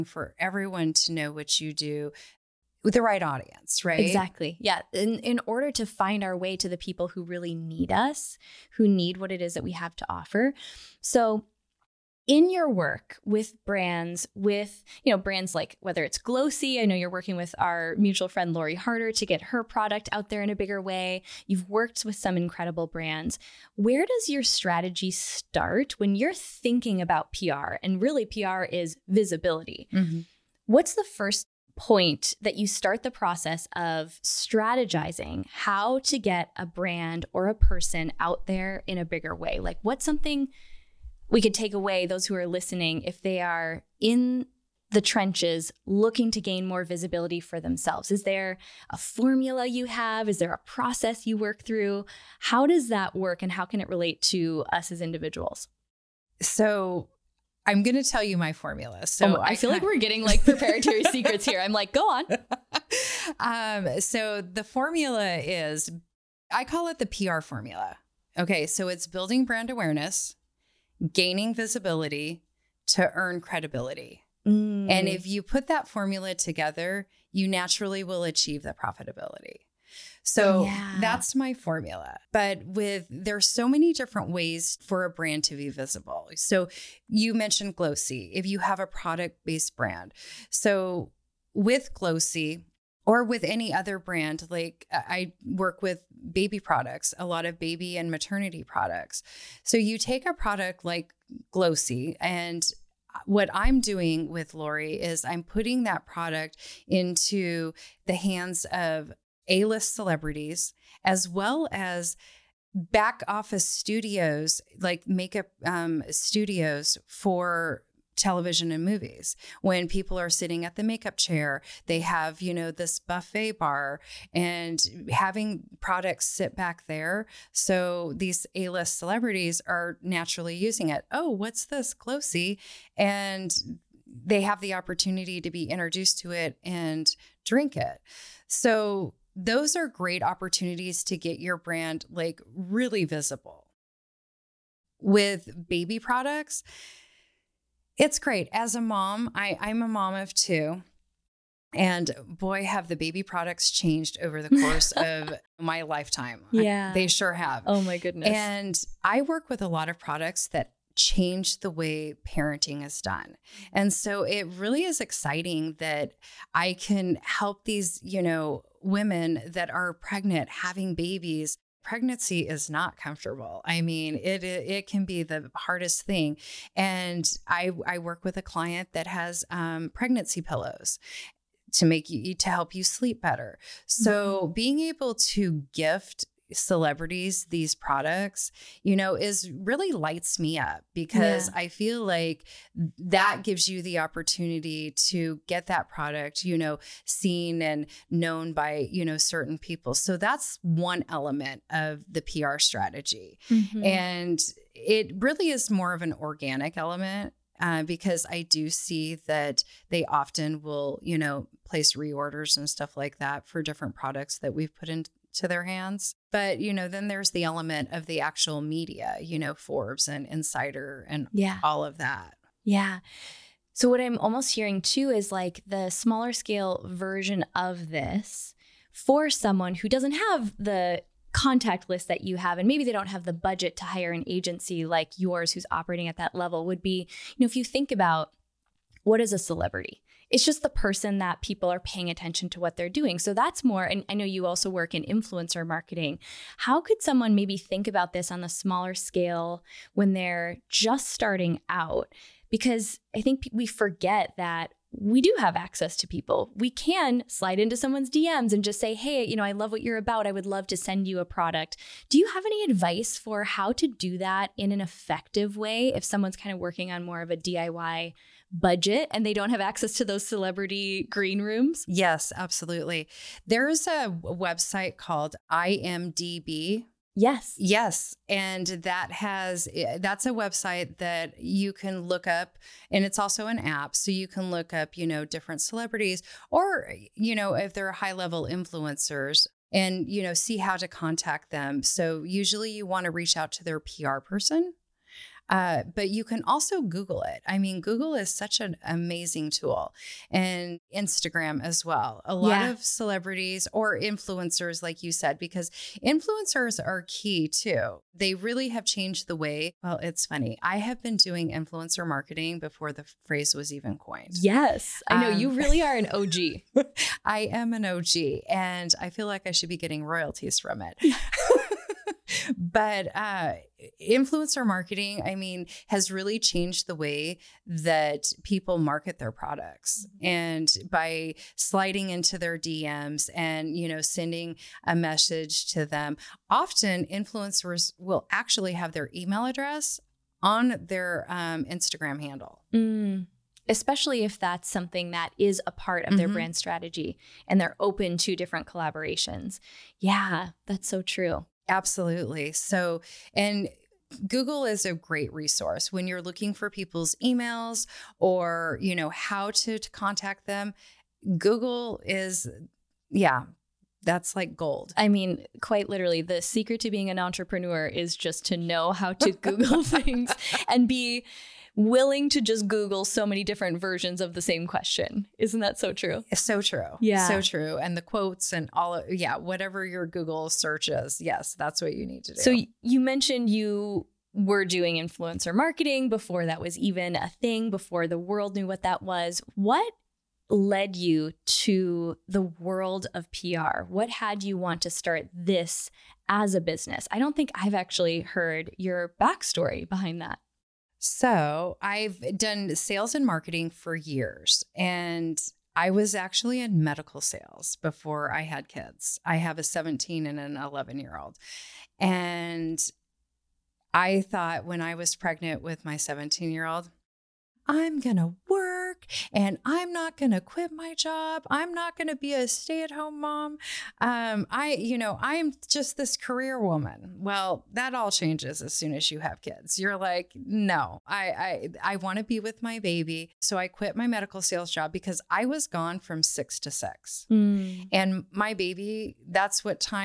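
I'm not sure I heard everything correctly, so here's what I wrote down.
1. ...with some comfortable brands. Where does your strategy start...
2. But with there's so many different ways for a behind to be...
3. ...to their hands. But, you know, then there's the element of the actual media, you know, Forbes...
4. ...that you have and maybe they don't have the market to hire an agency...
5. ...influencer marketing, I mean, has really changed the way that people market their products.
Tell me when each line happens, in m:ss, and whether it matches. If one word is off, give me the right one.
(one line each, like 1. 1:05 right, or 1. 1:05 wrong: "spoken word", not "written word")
1. 0:22 wrong: "incredible", not "comfortable"
2. 1:22 wrong: "brand", not "behind"
3. 3:35 right
4. 3:52 wrong: "budget", not "market"
5. 5:24 right.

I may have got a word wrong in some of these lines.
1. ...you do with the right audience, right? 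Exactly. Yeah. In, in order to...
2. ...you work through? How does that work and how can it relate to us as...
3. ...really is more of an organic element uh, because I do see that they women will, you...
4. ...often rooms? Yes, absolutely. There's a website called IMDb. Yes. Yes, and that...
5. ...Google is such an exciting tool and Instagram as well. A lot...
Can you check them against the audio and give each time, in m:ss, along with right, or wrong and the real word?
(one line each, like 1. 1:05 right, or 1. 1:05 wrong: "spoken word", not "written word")
1. 0:01 right
2. 0:51 right
3. 3:25 wrong: "often", not "women"
4. 4:31 wrong: "green", not "often"
5. 4:57 wrong: "amazing", not "exciting".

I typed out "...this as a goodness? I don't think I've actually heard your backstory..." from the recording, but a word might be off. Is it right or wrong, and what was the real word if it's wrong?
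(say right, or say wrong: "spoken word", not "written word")
wrong: "business", not "goodness".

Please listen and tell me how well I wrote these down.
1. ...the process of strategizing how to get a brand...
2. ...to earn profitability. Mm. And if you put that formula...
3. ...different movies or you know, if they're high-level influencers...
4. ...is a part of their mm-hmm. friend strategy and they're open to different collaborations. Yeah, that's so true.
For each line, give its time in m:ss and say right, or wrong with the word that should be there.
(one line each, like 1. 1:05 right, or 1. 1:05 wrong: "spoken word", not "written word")
1. 0:33 right
2. 1:12 wrong: "credibility", not "profitability"
3. 4:45 wrong: "celebrities", not "movies"
4. 5:45 wrong: "brand", not "friend".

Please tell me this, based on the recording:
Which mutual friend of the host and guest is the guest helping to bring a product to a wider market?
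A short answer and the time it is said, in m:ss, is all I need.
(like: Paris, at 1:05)
Lori Harder, at 0:18.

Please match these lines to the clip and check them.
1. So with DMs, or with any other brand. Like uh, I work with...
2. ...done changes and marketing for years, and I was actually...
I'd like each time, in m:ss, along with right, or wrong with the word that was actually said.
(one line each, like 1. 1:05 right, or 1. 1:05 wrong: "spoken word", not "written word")
1. 1:30 wrong: "Glossy", not "DMs"
2. 6:42 wrong: "sales", not "changes".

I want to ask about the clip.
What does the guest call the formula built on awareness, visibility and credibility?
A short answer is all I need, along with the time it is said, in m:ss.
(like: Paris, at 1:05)
the PR formula, at 1:06.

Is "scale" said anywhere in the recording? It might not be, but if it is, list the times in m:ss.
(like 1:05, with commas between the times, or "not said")
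3:46, 4:08.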